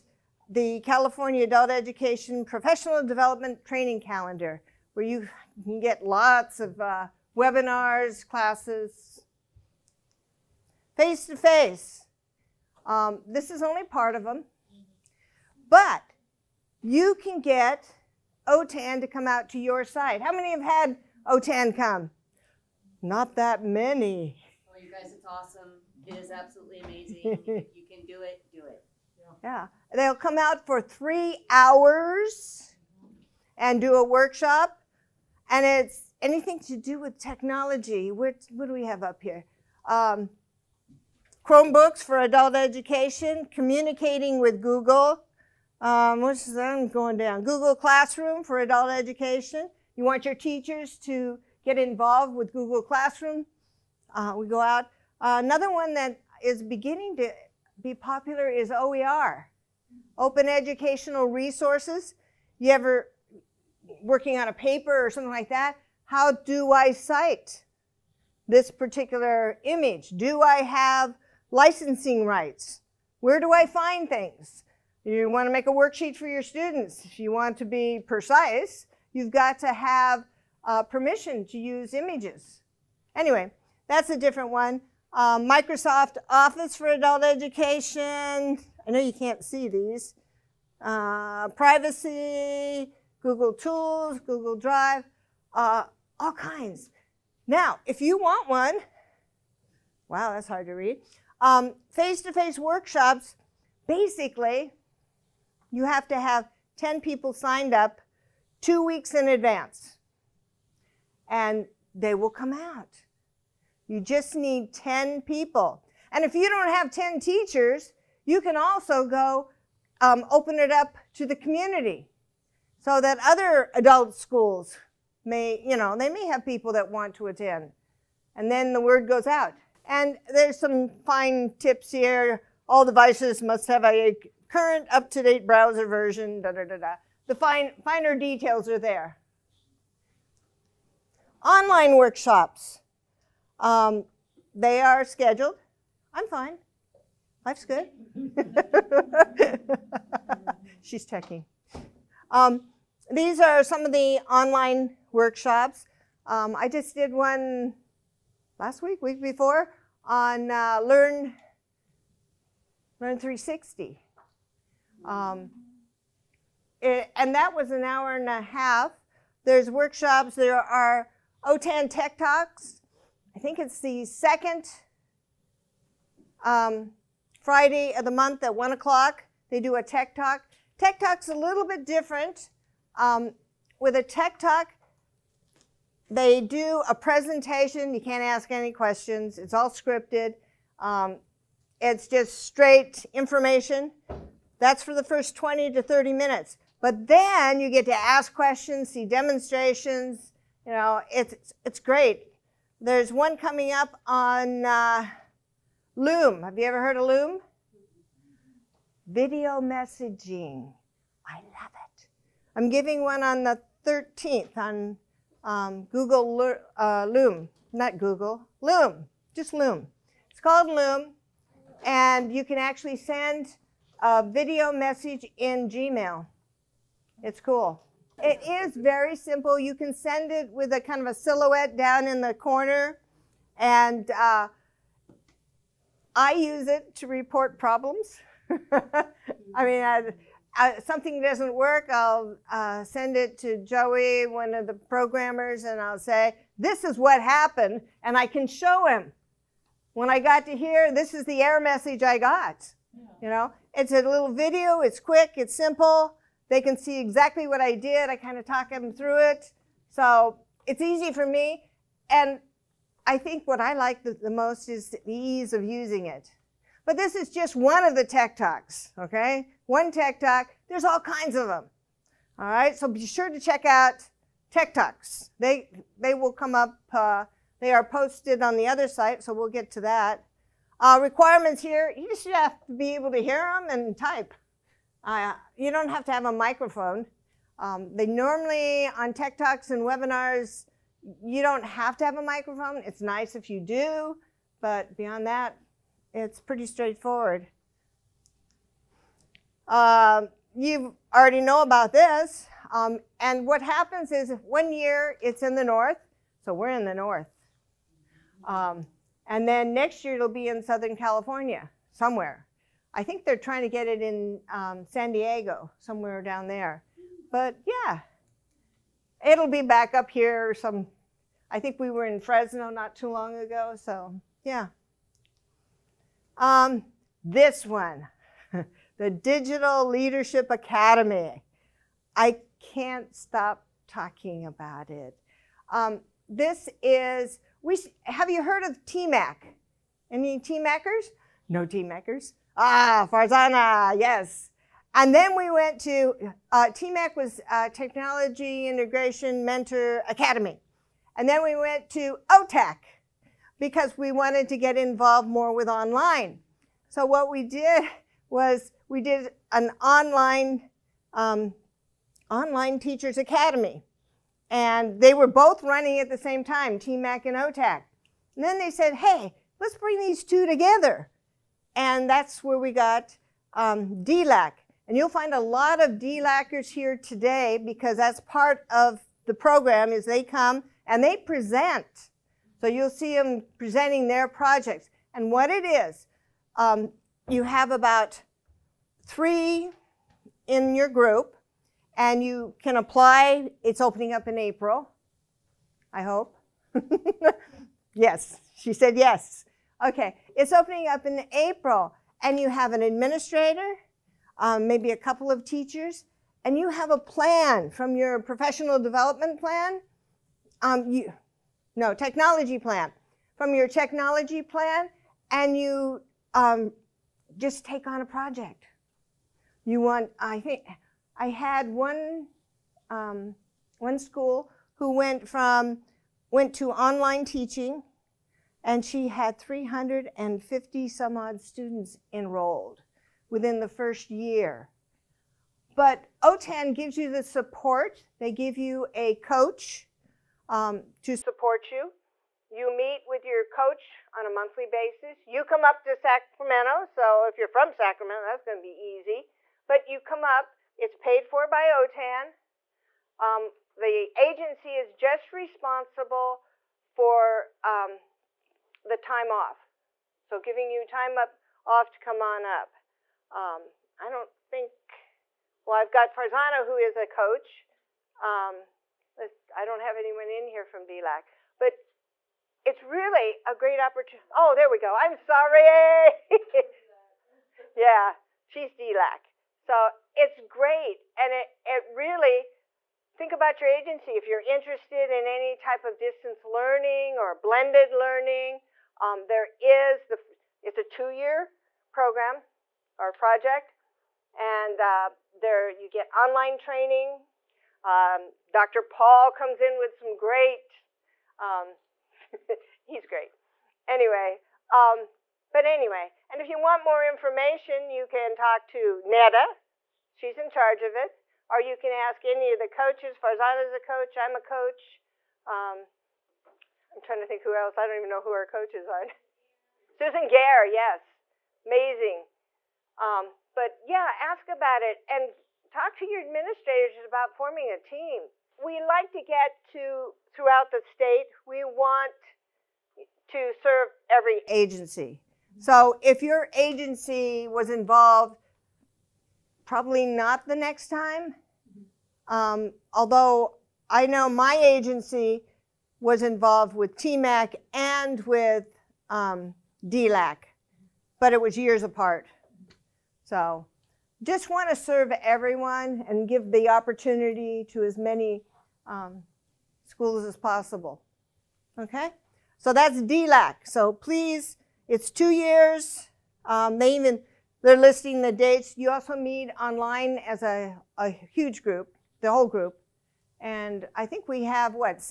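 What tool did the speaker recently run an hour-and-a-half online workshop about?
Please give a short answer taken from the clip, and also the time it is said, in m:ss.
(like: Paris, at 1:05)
Learn 360, at 2:42.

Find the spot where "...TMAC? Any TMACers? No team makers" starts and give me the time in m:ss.
5:38.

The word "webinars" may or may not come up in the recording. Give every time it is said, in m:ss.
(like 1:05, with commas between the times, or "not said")
0:07, 4:49.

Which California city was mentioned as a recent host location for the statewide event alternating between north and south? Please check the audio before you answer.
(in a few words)
Fresno.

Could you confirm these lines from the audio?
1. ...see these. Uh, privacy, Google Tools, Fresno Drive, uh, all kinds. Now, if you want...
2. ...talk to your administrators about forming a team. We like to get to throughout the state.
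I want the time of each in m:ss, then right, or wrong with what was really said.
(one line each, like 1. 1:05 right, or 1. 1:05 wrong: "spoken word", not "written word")
1. 1:29 wrong: "Google", not "Fresno"
2. 8:45 right.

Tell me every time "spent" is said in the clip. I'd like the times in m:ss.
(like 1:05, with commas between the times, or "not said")
not said.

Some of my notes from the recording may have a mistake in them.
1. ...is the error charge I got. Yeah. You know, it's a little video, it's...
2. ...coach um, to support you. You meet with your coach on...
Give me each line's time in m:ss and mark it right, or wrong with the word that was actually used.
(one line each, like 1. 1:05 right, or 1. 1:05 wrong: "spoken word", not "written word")
1. 4:11 wrong: "message", not "charge"
2. 7:19 right.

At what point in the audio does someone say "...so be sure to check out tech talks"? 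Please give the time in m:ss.
4:32.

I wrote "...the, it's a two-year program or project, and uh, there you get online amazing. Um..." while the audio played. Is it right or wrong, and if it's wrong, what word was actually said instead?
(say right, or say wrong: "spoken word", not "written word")
wrong: "training", not "amazing".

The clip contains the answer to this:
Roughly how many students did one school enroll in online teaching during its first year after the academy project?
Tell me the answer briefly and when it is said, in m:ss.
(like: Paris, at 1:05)
350, at 7:09.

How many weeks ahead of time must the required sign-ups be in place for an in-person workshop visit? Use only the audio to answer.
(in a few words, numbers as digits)
2 weeks.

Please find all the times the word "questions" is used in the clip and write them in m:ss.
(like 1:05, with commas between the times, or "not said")
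3:08, 3:18.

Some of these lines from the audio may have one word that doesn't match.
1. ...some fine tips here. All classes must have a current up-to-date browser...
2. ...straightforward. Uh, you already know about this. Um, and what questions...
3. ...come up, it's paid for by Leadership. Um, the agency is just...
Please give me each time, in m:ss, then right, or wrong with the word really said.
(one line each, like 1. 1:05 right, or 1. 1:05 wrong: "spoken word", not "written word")
1. 2:10 wrong: "devices", not "classes"
2. 4:56 wrong: "happens", not "questions"
3. 7:30 wrong: "OTAN", not "Leadership".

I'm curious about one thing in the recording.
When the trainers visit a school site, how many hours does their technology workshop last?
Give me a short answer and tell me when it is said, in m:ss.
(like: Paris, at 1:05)
3 hours, at 0:30.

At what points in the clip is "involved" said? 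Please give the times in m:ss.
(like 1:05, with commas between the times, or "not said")
0:51, 5:54, 8:57, 9:06.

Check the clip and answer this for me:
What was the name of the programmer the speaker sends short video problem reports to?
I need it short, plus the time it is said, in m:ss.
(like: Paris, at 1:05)
Joey, at 4:03.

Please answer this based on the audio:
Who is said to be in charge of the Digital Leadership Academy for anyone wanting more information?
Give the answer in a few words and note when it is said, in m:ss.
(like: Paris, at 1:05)
Neda, at 8:29.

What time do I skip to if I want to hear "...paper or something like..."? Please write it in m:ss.
1:04.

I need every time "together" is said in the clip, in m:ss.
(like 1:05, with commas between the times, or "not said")
6:10.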